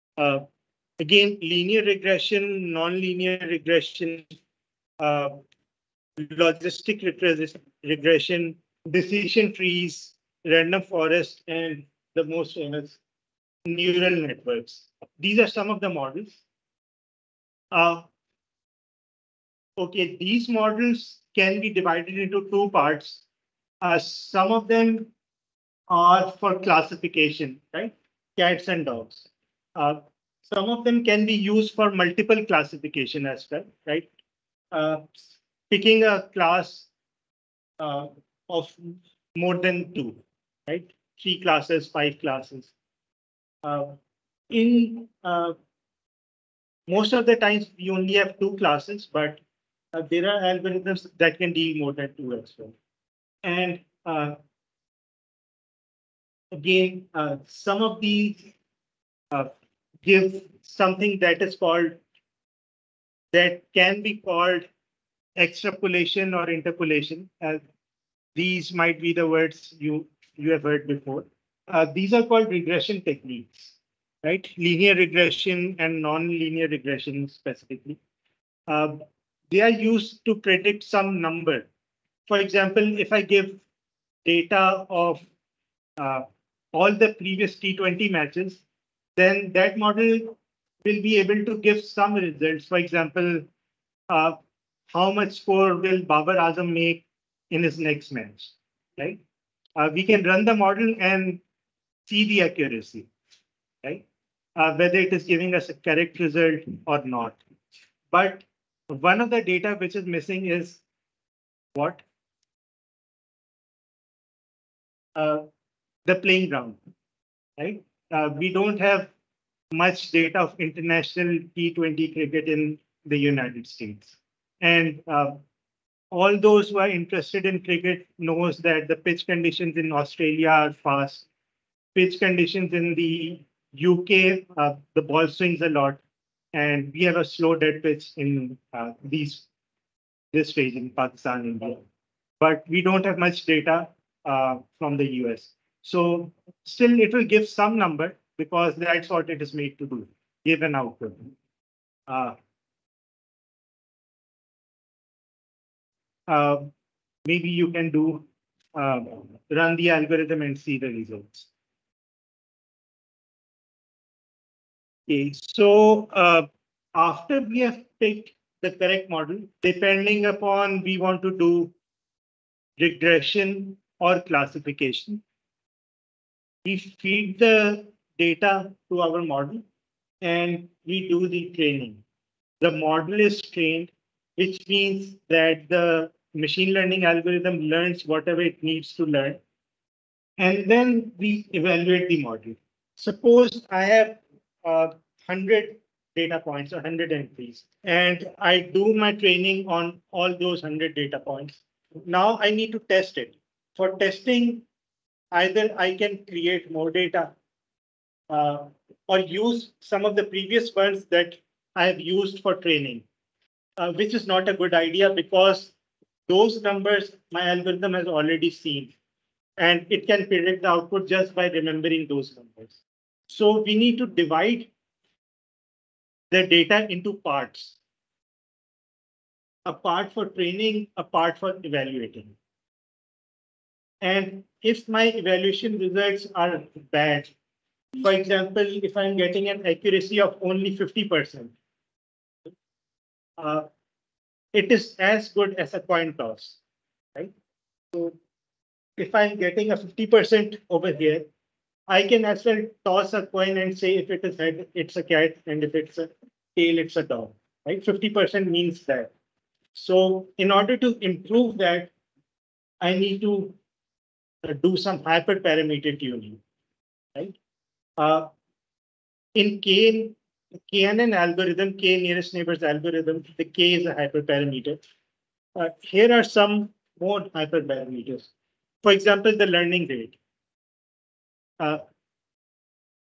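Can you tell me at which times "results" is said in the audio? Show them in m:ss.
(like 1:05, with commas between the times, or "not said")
1:32, 1:46, 2:40, 3:55.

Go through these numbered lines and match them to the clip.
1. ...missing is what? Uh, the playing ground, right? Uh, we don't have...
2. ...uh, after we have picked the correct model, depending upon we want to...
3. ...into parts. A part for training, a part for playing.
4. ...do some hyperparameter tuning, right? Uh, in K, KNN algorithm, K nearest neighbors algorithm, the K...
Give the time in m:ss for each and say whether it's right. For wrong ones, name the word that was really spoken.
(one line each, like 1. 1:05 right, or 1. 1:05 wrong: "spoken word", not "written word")
1. 1:50 right
2. 2:46 right
3. 3:46 wrong: "evaluating", not "playing"
4. 4:24 right.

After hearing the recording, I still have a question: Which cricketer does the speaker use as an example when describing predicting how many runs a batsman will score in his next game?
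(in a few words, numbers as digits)
Babar Azam.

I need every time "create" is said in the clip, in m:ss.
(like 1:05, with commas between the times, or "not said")
3:26.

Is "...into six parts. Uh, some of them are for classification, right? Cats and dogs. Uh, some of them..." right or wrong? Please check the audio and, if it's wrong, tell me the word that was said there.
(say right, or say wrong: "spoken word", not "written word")
wrong: "two", not "six".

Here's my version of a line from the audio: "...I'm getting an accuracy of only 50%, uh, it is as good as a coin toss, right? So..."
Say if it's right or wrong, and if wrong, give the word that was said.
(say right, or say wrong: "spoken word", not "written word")
right.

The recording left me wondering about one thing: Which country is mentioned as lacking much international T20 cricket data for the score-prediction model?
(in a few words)
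United States.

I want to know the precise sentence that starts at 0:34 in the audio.
Uh, picking a class uh, of more than two, right?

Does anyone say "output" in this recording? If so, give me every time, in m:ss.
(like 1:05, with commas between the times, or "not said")
2:30, 3:40.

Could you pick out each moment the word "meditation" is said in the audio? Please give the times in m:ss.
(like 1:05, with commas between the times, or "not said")
not said.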